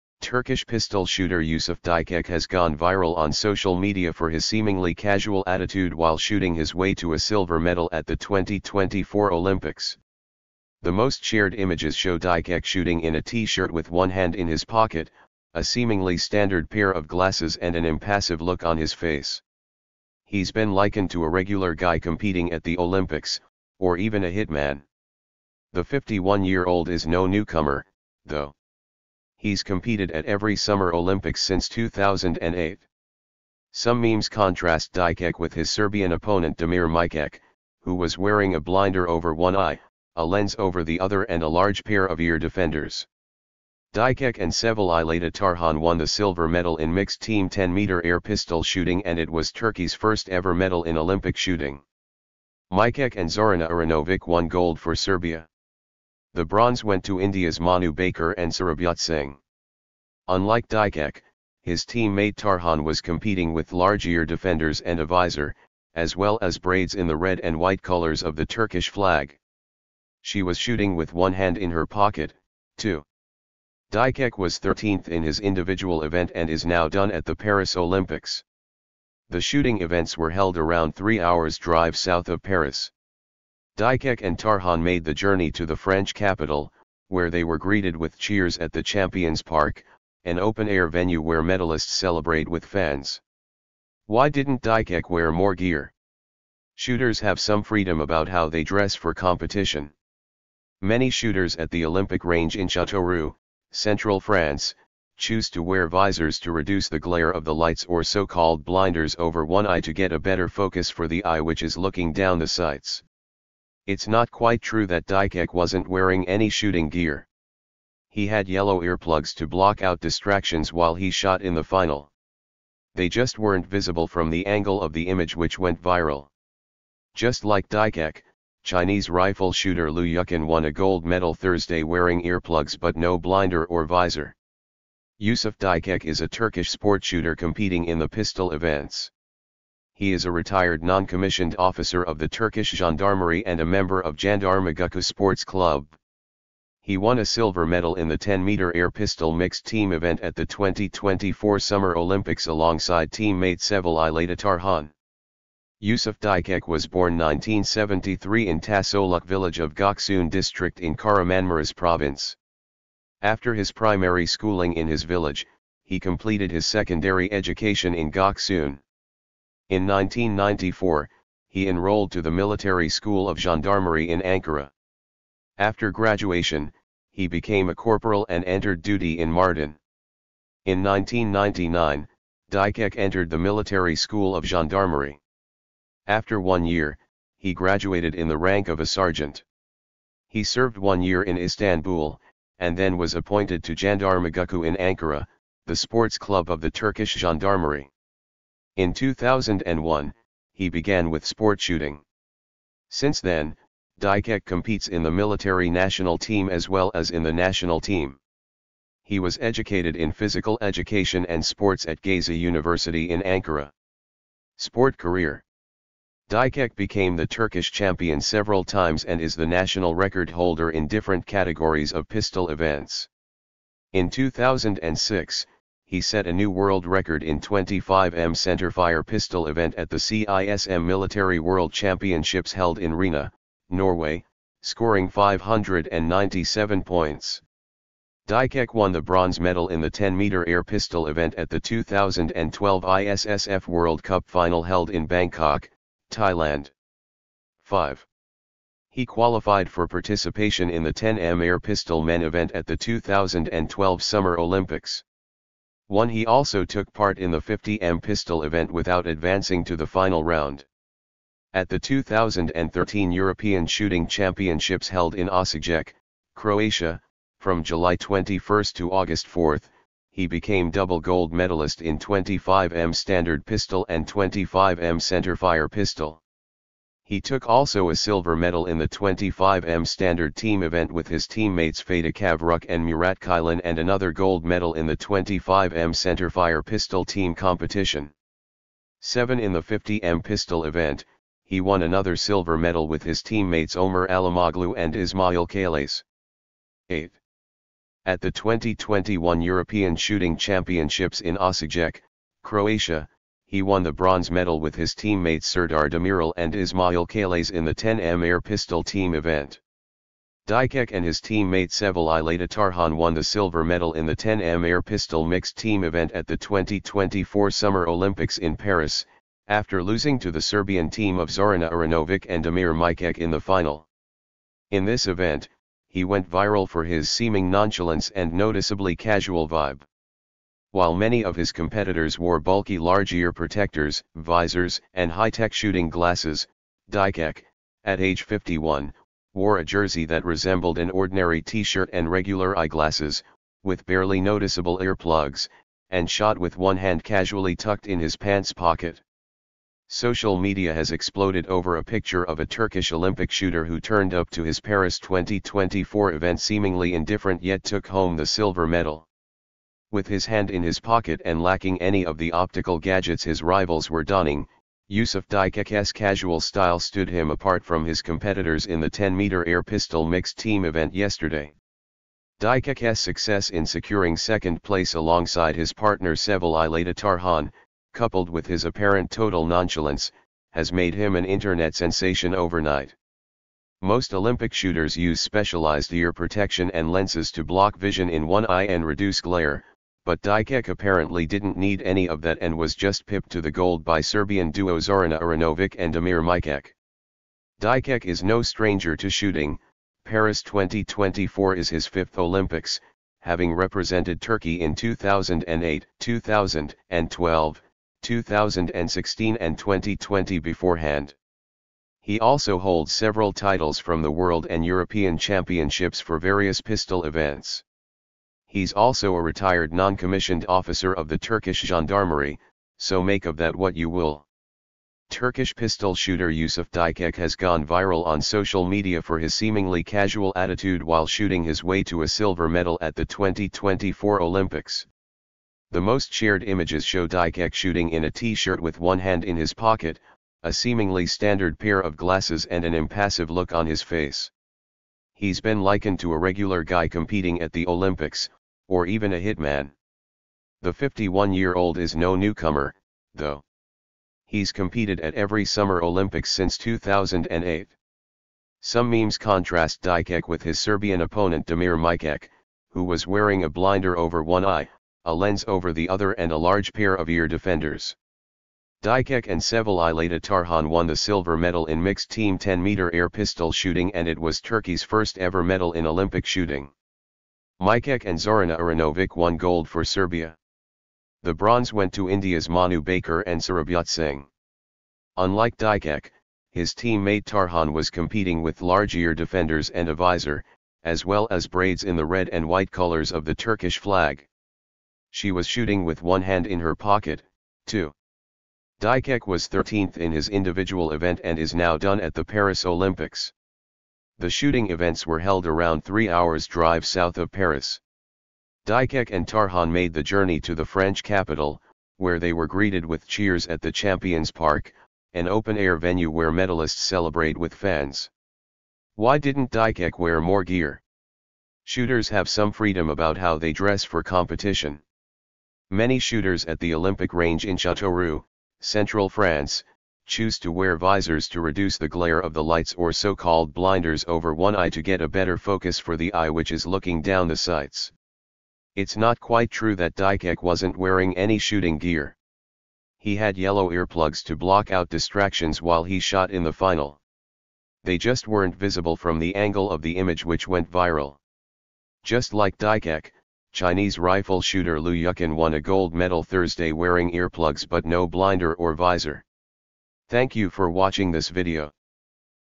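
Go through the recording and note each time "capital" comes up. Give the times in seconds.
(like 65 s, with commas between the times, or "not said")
86 s, 511 s.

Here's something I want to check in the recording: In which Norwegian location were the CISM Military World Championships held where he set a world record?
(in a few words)
Rena.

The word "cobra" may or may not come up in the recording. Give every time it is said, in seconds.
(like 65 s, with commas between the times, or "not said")
not said.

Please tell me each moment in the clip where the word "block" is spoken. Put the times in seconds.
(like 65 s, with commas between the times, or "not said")
119 s, 387 s, 544 s.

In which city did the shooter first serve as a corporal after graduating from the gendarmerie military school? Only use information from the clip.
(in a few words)
Mardin.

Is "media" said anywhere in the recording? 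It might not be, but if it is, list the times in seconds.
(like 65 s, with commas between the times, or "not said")
3 s, 350 s, 428 s.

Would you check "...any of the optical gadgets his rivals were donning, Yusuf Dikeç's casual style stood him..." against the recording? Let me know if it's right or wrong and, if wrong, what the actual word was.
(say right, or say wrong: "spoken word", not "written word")
right.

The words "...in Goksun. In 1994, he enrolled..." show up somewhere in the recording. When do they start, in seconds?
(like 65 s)
167 s.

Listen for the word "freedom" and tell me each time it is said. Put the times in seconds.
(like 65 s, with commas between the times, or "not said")
97 s, 522 s.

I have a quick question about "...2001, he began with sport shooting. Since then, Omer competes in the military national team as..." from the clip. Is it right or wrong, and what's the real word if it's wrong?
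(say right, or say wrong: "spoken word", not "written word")
wrong: "Dikeç", not "Omer".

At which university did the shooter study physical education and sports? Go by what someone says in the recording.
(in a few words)
Gazi University.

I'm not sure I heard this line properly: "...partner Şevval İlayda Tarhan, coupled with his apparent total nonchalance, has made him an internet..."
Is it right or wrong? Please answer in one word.
right.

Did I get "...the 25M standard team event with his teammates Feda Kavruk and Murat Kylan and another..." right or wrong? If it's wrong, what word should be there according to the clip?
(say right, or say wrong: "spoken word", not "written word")
right.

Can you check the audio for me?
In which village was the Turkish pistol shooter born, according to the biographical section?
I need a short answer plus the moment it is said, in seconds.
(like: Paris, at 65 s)
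Tasoluk, at 158 s.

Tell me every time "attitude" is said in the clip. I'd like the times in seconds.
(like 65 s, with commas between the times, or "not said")
5 s, 430 s.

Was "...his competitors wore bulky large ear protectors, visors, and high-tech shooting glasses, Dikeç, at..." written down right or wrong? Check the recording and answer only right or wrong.
right.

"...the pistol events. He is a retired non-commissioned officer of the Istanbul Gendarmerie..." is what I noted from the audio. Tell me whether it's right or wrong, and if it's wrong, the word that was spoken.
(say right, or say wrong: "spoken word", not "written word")
wrong: "Turkish", not "Istanbul".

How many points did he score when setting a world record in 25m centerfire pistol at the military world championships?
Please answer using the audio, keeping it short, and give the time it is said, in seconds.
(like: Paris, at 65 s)
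597, at 235 s.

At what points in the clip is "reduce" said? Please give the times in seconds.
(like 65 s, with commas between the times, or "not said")
106 s, 388 s, 531 s.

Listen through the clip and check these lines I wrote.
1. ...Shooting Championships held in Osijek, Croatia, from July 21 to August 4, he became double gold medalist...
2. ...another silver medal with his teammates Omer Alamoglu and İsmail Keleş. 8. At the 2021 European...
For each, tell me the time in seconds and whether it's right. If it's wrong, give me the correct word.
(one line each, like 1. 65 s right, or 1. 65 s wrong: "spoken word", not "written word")
1. 263 s right
2. 291 s right.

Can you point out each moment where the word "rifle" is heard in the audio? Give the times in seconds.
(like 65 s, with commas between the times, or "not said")
129 s, 553 s.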